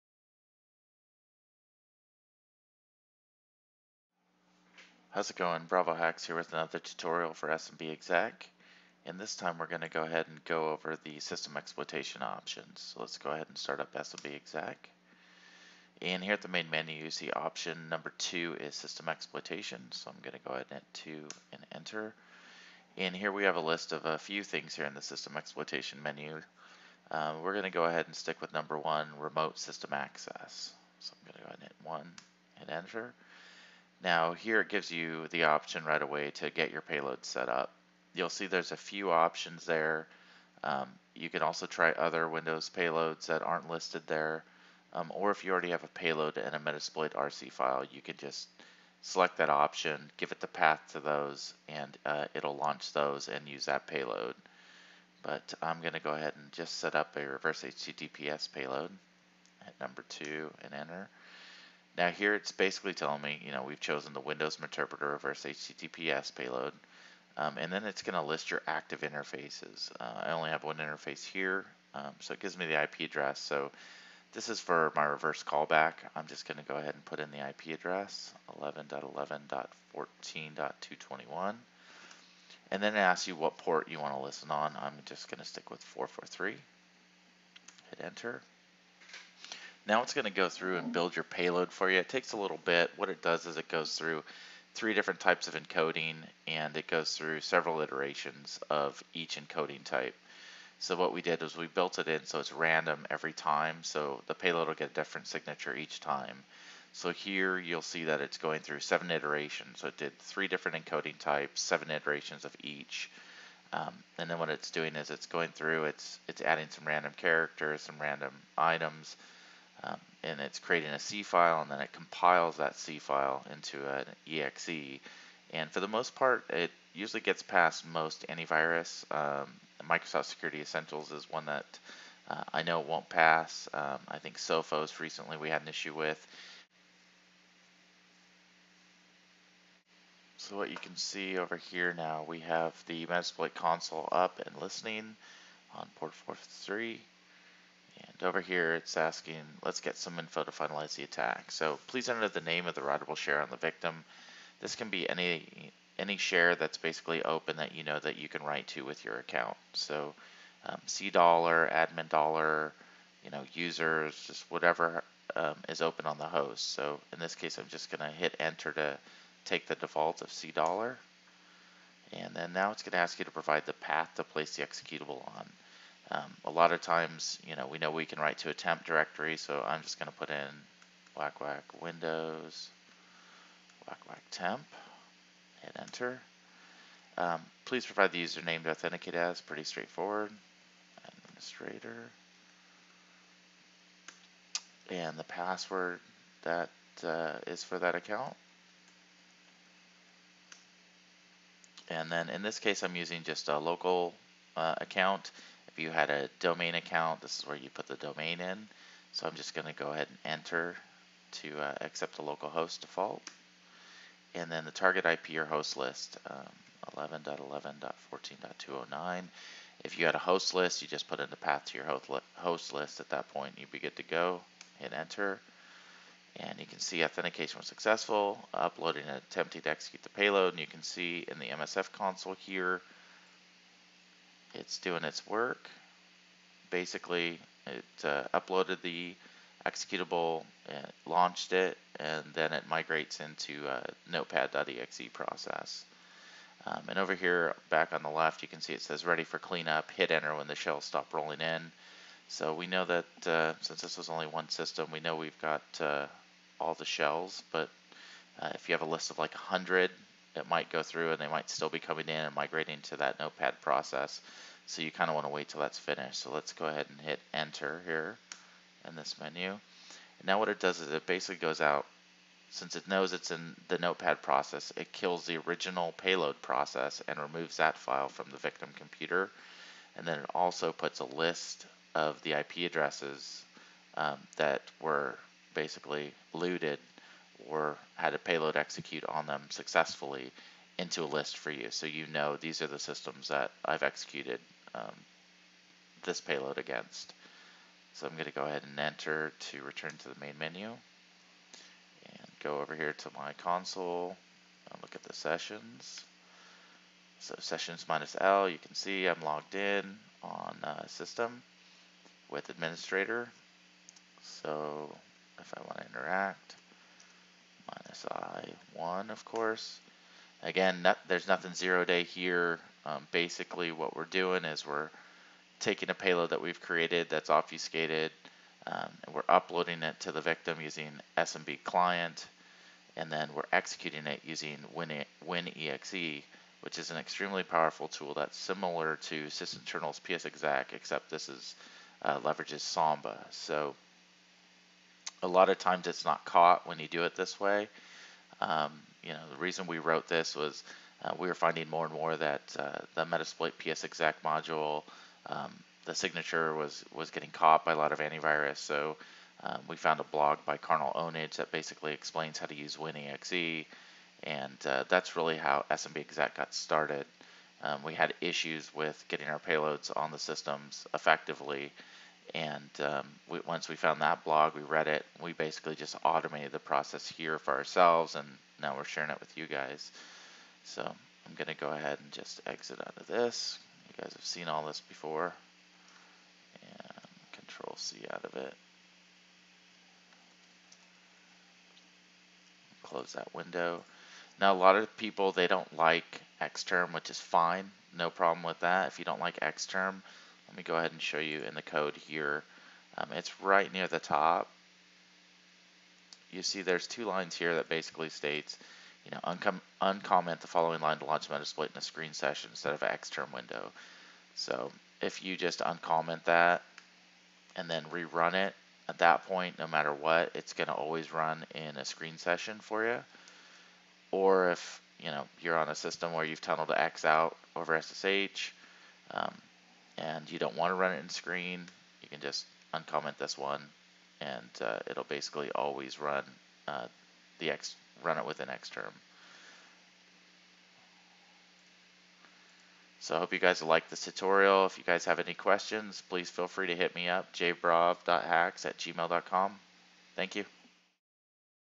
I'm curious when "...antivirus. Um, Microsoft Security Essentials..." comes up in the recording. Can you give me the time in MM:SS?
02:08.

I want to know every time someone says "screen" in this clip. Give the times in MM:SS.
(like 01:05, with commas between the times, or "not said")
06:51, 07:01, 07:11.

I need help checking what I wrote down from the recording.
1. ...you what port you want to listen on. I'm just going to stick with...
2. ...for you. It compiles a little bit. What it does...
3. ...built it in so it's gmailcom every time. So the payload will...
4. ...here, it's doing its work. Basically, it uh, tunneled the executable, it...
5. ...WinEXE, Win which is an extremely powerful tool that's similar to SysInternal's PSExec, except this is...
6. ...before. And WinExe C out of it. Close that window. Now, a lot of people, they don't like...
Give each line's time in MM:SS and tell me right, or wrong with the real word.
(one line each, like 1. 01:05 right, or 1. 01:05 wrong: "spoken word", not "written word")
1. 01:23 right
2. 01:31 wrong: "takes", not "compiles"
3. 01:41 wrong: "random", not "gmailcom"
4. 03:52 wrong: "uploaded", not "tunneled"
5. 05:34 right
6. 06:24 wrong: "Control", not "WinExe".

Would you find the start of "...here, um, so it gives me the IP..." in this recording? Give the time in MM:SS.
01:11.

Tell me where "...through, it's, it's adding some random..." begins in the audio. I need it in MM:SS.
01:55.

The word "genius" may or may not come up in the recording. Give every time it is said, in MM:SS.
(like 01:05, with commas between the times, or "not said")
not said.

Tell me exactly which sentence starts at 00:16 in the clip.
And here at the main menu you see option number two is system exploitation.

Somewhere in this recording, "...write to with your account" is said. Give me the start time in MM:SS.
02:38.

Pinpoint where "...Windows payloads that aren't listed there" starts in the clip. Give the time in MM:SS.
00:42.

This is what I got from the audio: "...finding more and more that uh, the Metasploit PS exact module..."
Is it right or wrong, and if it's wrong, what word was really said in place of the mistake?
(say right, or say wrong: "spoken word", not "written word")
right.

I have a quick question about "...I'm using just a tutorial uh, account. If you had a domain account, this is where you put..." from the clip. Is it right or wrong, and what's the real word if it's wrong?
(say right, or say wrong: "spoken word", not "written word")
wrong: "local", not "tutorial".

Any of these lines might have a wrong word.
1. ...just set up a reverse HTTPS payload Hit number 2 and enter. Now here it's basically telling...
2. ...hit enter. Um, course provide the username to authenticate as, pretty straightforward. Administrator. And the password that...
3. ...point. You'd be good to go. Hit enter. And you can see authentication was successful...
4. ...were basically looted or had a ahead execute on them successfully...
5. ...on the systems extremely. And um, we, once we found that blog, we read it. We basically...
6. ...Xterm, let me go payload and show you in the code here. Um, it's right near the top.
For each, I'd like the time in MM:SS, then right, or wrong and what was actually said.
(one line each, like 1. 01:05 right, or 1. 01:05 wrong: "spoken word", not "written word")
1. 00:56 right
2. 03:05 wrong: "please", not "course"
3. 03:43 right
4. 04:44 wrong: "payload", not "ahead"
5. 06:09 wrong: "effectively", not "extremely"
6. 06:39 wrong: "ahead", not "payload".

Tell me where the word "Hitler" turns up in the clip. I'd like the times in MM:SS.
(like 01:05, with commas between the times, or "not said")
not said.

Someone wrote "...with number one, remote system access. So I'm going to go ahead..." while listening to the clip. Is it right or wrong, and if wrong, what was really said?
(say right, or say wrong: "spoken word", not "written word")
right.